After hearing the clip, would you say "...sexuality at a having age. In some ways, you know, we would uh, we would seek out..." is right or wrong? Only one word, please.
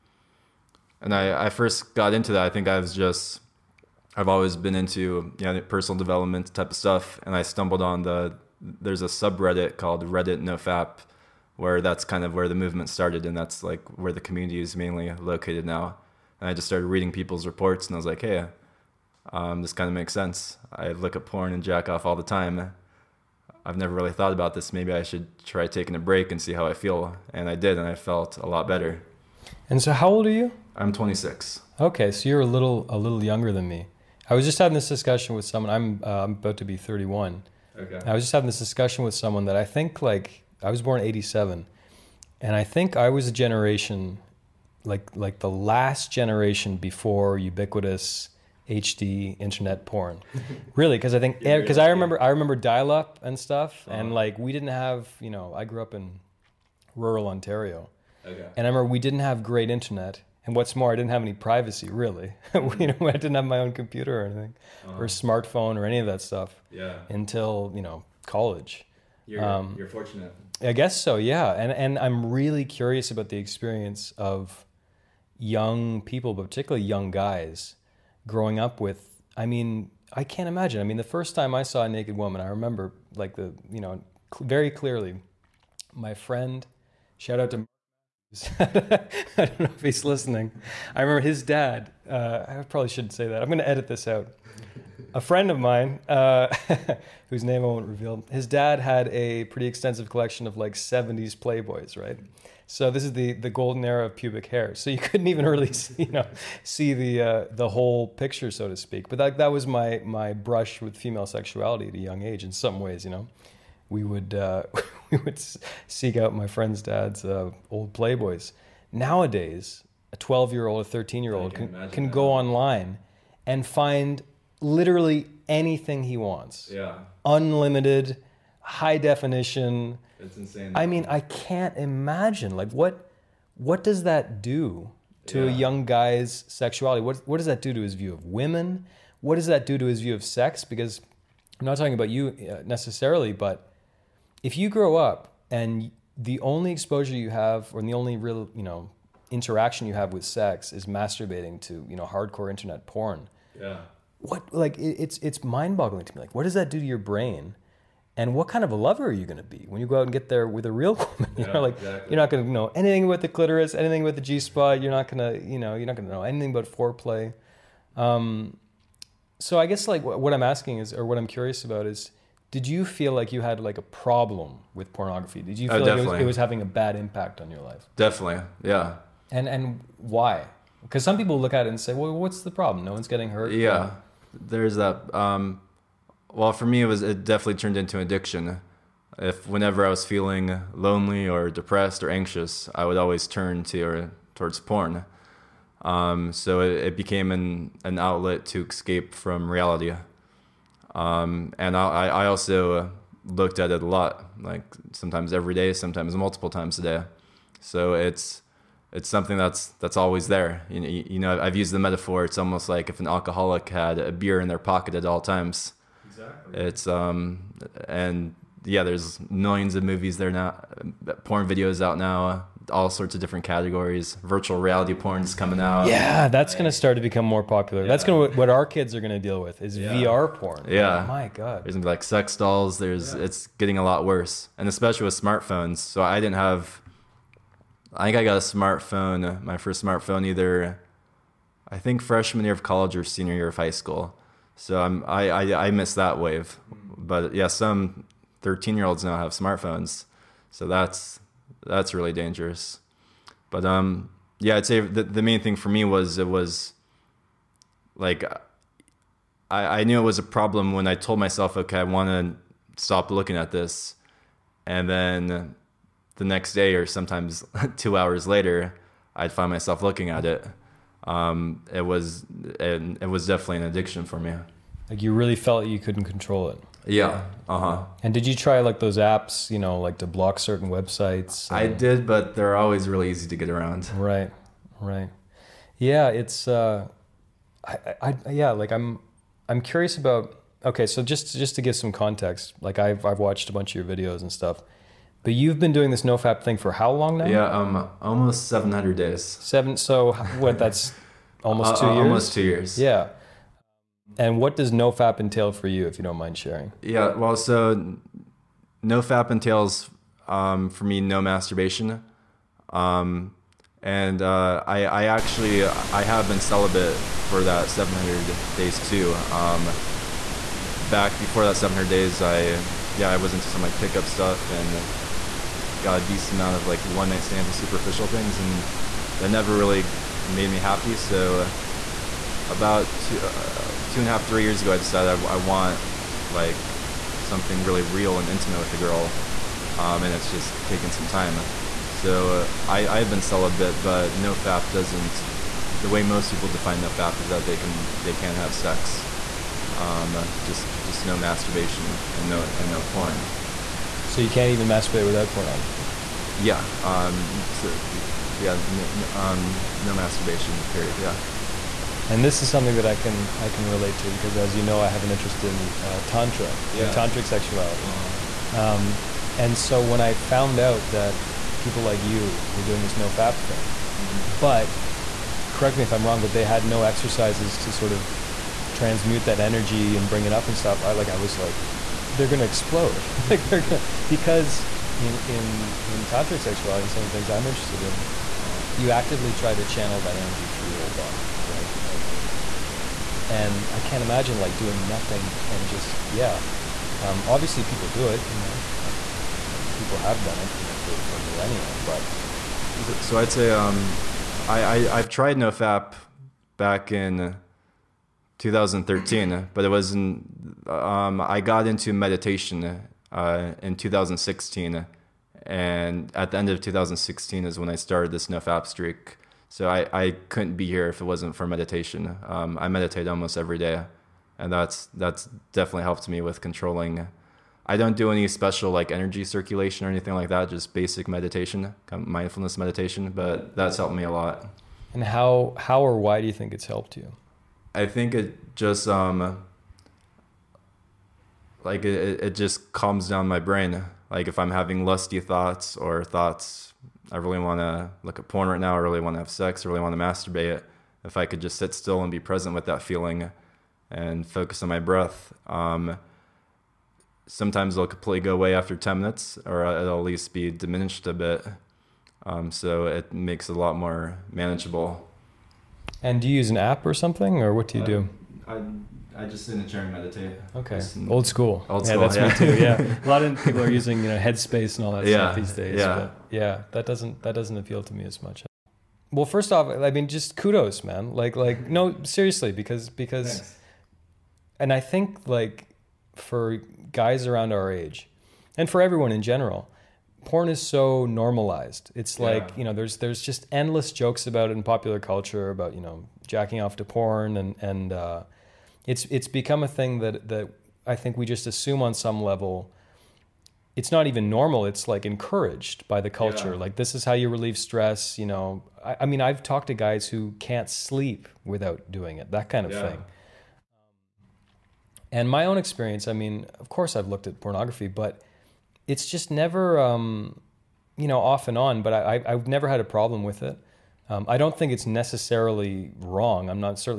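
wrong.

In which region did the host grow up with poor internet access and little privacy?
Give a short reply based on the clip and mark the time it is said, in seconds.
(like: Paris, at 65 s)
Rural Ontario, at 56 s.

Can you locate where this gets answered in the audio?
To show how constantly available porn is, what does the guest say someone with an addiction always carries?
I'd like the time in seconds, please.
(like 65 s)
213 s.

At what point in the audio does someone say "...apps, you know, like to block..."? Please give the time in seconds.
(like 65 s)
278 s.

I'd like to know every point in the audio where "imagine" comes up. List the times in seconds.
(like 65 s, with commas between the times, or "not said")
80 s, 131 s, 394 s.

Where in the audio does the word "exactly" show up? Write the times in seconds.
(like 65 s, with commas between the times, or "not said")
161 s, 216 s.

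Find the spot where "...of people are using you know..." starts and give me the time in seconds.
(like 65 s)
473 s.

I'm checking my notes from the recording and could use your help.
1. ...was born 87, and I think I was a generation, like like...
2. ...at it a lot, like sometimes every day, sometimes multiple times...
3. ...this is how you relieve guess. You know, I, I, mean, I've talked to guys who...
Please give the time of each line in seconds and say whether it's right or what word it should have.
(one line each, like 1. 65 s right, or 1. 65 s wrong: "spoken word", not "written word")
1. 40 s right
2. 203 s right
3. 506 s wrong: "stress", not "guess".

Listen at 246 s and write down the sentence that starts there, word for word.
But yeah, some 13 year olds now have smartphones.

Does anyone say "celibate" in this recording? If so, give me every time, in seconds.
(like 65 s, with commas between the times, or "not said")
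316 s, 343 s.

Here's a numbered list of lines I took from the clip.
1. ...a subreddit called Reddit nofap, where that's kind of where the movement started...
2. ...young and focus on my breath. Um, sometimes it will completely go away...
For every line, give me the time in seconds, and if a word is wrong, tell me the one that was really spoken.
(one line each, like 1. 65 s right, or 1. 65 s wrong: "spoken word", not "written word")
1. 9 s right
2. 452 s wrong: "feeling", not "young".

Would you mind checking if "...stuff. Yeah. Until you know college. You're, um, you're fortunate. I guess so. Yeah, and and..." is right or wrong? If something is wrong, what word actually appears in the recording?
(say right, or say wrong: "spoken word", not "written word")
right.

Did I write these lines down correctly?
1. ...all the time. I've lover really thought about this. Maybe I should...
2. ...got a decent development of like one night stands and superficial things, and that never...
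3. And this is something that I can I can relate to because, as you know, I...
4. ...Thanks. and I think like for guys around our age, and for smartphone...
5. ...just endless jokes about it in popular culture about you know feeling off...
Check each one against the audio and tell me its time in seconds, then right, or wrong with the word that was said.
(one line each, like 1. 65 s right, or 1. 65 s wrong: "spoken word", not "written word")
1. 22 s wrong: "never", not "lover"
2. 325 s wrong: "amount", not "development"
3. 362 s right
4. 483 s wrong: "everyone", not "smartphone"
5. 493 s wrong: "jacking", not "feeling".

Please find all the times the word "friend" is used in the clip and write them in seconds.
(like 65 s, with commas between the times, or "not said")
86 s, 95 s, 116 s.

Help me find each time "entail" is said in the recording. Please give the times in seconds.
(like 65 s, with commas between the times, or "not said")
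305 s, 309 s.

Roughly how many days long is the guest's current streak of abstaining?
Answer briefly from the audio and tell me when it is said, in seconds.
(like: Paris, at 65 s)
700, at 298 s.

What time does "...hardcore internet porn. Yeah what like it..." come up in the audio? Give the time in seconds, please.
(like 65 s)
152 s.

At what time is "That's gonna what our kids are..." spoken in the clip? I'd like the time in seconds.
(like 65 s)
227 s.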